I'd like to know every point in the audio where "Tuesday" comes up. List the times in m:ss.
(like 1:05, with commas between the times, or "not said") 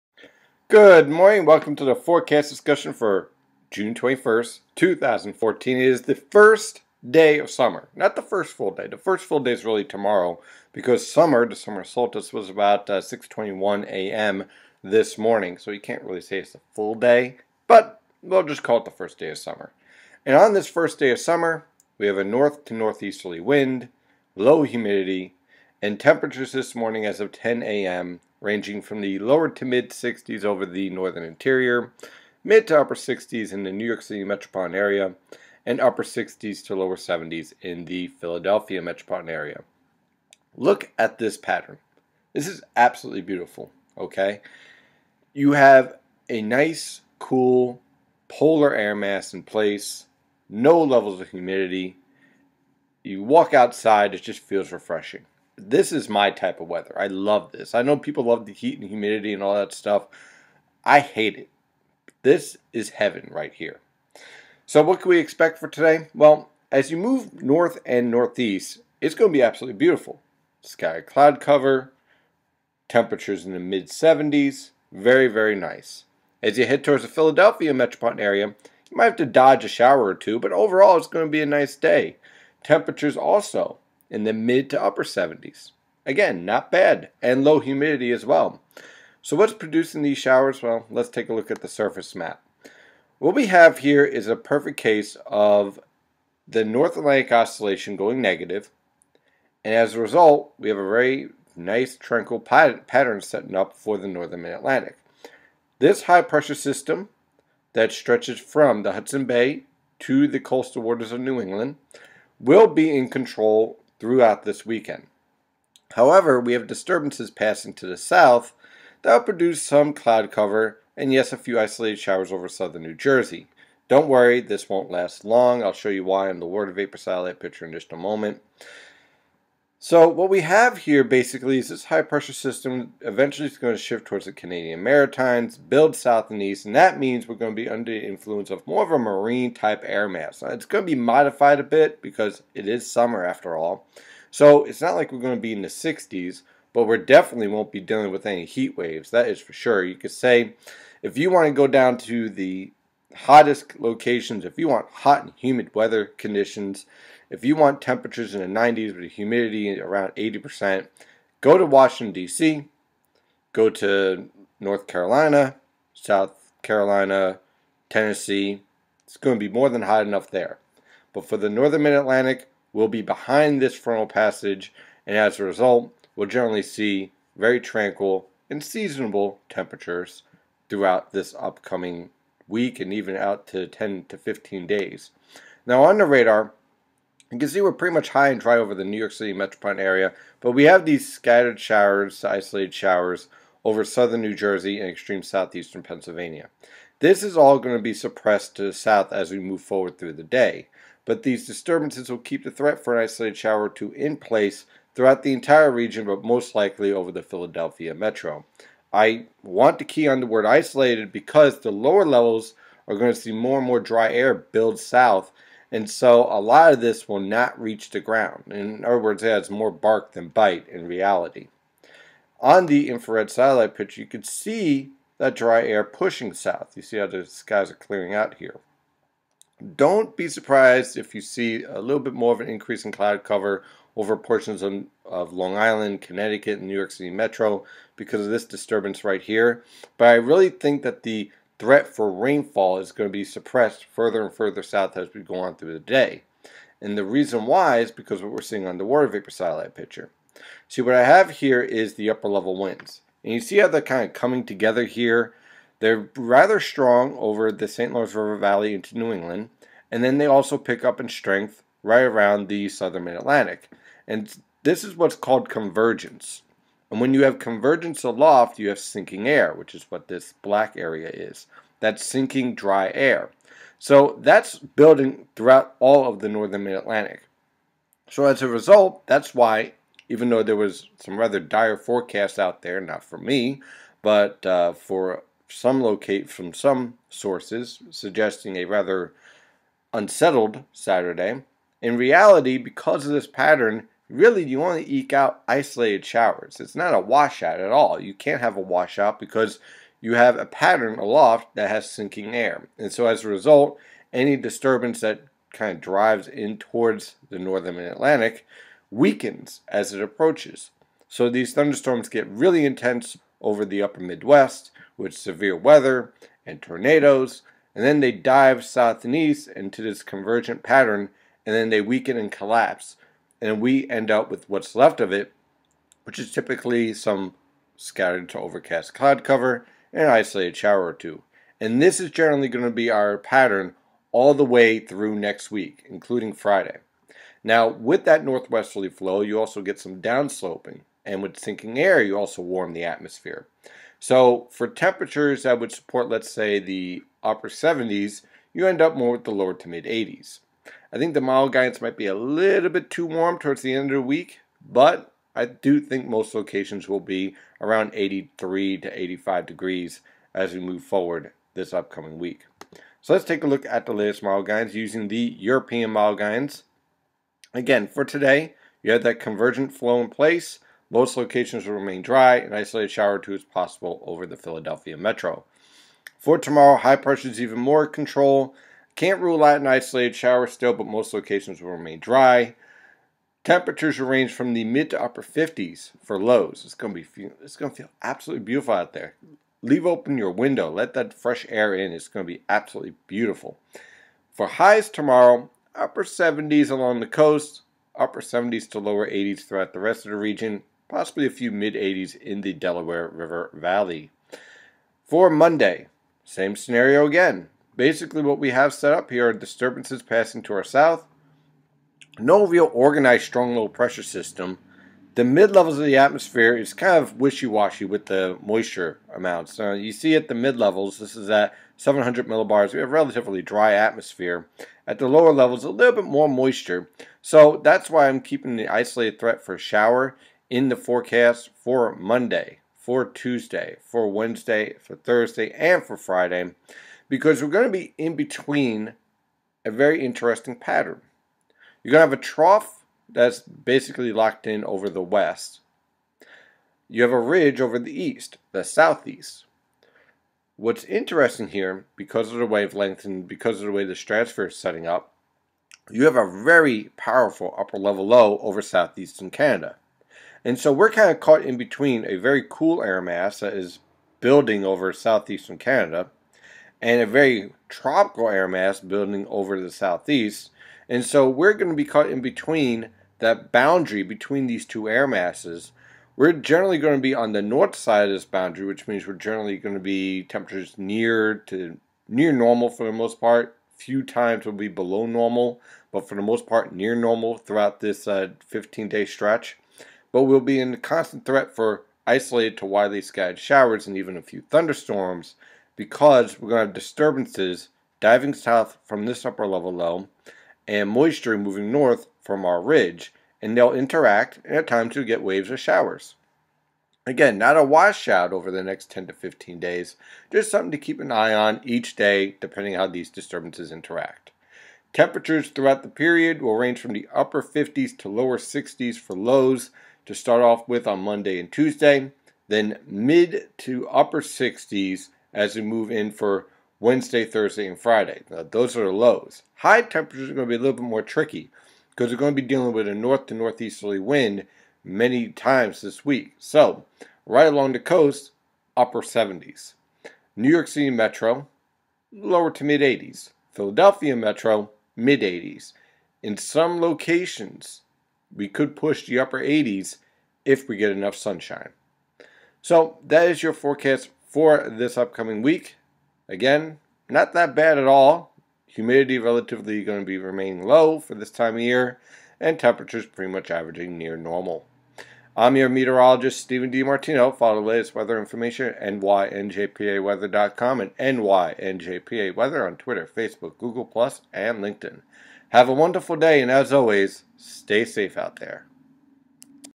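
7:13, 8:41.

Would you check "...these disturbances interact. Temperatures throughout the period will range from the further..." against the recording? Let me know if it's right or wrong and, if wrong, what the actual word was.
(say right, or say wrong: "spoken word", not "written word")
wrong: "upper", not "further".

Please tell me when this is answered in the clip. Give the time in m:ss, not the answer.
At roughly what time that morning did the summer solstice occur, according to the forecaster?
0:13.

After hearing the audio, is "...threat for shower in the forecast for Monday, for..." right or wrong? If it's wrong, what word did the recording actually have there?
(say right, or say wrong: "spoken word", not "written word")
right.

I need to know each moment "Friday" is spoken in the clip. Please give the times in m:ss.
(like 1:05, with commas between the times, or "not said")
5:36, 7:15, 8:47.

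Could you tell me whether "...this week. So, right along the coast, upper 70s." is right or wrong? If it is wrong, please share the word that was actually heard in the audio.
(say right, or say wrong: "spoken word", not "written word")
right.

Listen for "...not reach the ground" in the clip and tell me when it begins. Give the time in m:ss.
3:37.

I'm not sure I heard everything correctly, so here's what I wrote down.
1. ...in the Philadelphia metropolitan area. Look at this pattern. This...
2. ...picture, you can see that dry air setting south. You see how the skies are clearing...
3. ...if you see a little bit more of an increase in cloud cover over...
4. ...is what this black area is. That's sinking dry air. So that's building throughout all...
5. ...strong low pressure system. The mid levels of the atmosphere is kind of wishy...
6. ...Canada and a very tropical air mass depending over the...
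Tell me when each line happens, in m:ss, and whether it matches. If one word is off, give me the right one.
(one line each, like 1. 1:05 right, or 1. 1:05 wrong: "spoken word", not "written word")
1. 0:37 right
2. 3:43 wrong: "pushing", not "setting"
3. 3:50 right
4. 4:29 right
5. 6:53 right
6. 7:45 wrong: "building", not "depending".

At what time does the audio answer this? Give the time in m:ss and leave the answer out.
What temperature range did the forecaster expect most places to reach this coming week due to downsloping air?
5:57.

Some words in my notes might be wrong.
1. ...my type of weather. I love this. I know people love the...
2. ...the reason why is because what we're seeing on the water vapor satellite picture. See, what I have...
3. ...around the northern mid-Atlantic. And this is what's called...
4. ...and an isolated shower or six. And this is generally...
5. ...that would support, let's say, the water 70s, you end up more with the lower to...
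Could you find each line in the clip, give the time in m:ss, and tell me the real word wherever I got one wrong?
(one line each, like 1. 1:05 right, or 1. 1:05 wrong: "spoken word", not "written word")
1. 0:56 right
2. 4:06 right
3. 4:22 wrong: "southern", not "northern"
4. 5:29 wrong: "two", not "six"
5. 5:45 wrong: "upper", not "water".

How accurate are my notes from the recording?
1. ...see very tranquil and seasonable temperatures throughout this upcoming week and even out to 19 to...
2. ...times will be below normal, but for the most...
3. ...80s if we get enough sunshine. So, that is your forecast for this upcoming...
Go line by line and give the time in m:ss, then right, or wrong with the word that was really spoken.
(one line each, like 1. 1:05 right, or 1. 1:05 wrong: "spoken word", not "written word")
1. 2:56 wrong: "10", not "19"
2. 8:04 right
3. 9:09 right.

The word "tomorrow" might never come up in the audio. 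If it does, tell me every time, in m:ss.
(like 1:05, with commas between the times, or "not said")
0:09, 6:16, 6:34.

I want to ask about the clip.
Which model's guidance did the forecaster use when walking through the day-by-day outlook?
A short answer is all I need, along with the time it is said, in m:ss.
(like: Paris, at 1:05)
European model, at 6:05.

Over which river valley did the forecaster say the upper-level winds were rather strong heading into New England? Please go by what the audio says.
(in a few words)
St. Lawrence River Valley.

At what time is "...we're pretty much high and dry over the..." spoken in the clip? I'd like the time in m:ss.
3:07.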